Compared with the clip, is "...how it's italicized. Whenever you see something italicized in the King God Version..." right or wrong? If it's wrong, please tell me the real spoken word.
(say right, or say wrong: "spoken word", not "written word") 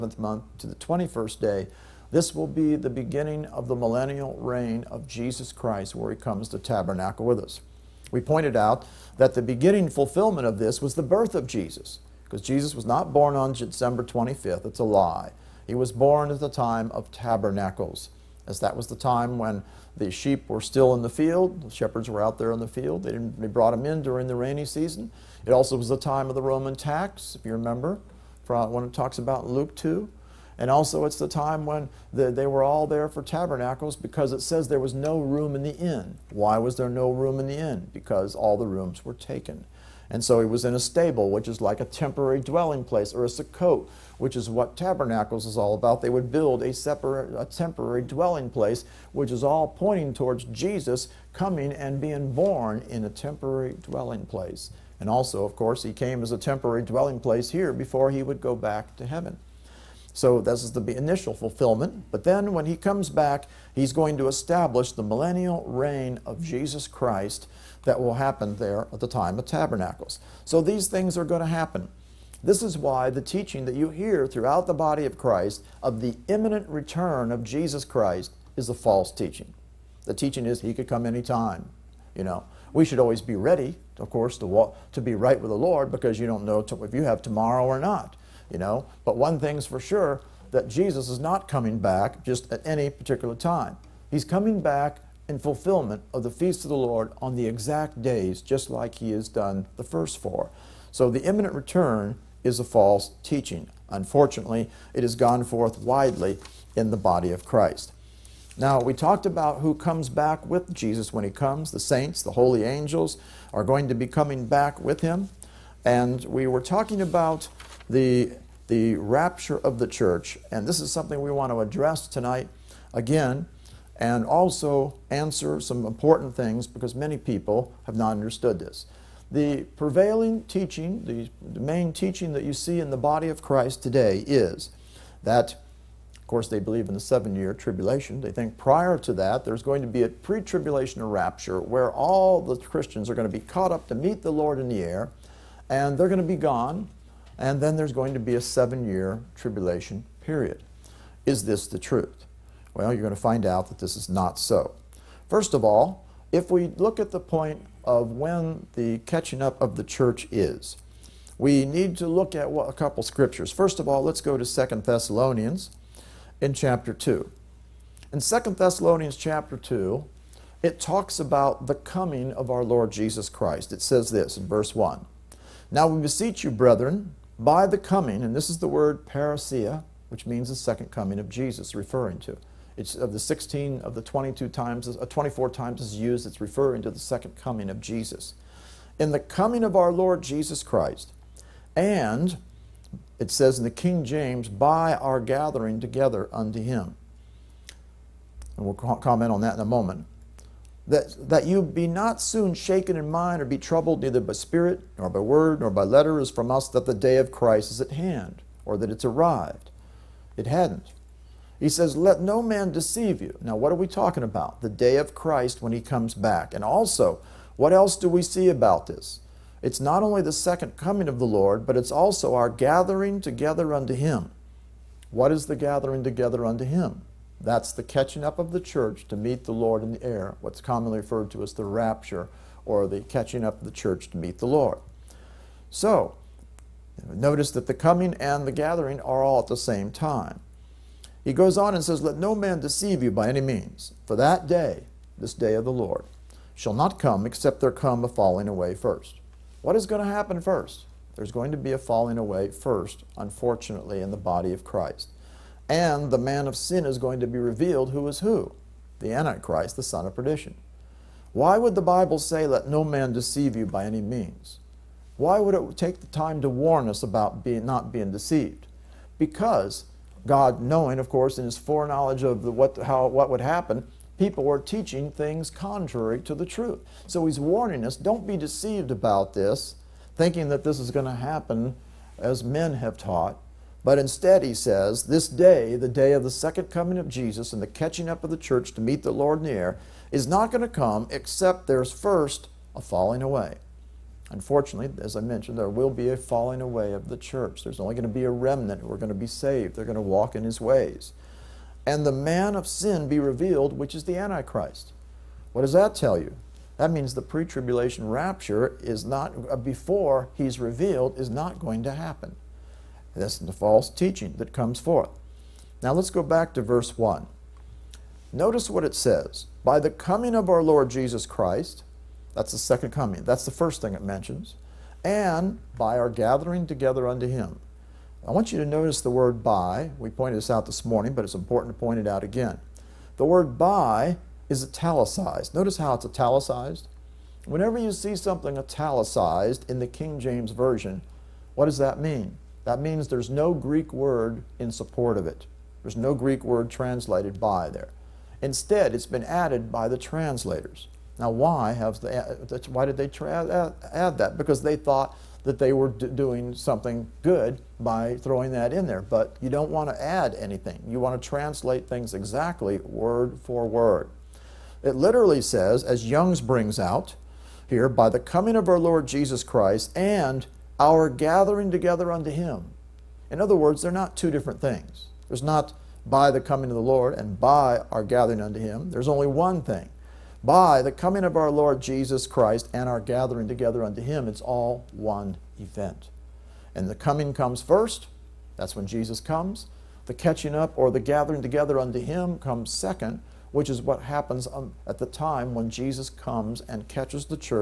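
wrong: "James", not "God".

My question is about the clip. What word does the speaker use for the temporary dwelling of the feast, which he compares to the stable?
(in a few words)
sukkot.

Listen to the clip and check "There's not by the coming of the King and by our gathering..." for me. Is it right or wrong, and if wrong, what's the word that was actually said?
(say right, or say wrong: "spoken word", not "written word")
wrong: "Lord", not "King".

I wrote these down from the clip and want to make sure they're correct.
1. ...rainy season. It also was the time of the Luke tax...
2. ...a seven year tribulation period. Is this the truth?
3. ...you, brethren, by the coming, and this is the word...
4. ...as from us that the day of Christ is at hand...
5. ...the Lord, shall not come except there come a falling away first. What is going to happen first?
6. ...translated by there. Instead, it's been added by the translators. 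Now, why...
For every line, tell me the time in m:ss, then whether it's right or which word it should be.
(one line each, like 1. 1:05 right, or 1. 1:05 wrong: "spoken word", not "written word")
1. 0:24 wrong: "Roman", not "Luke"
2. 2:28 right
3. 2:56 right
4. 3:26 right
5. 4:05 right
6. 5:46 right.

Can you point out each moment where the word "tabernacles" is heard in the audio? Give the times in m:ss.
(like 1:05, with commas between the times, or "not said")
0:06, 0:17, 0:33, 0:44, 1:09.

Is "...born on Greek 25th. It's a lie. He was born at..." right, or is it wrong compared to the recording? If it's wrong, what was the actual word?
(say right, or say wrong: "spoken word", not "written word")
wrong: "December", not "Greek".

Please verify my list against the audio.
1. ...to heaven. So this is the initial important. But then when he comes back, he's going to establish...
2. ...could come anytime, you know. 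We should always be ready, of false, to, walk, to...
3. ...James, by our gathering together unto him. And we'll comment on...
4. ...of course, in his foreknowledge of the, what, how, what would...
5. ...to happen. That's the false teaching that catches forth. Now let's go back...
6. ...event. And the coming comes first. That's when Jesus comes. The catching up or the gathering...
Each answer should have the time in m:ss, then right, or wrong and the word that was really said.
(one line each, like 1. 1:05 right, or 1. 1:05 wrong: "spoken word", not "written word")
1. 0:58 wrong: "fulfillment", not "important"
2. 1:20 wrong: "course", not "false"
3. 3:14 right
4. 4:30 right
5. 5:11 wrong: "comes", not "catches"
6. 6:25 right.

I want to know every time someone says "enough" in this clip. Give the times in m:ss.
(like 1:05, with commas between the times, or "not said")
not said.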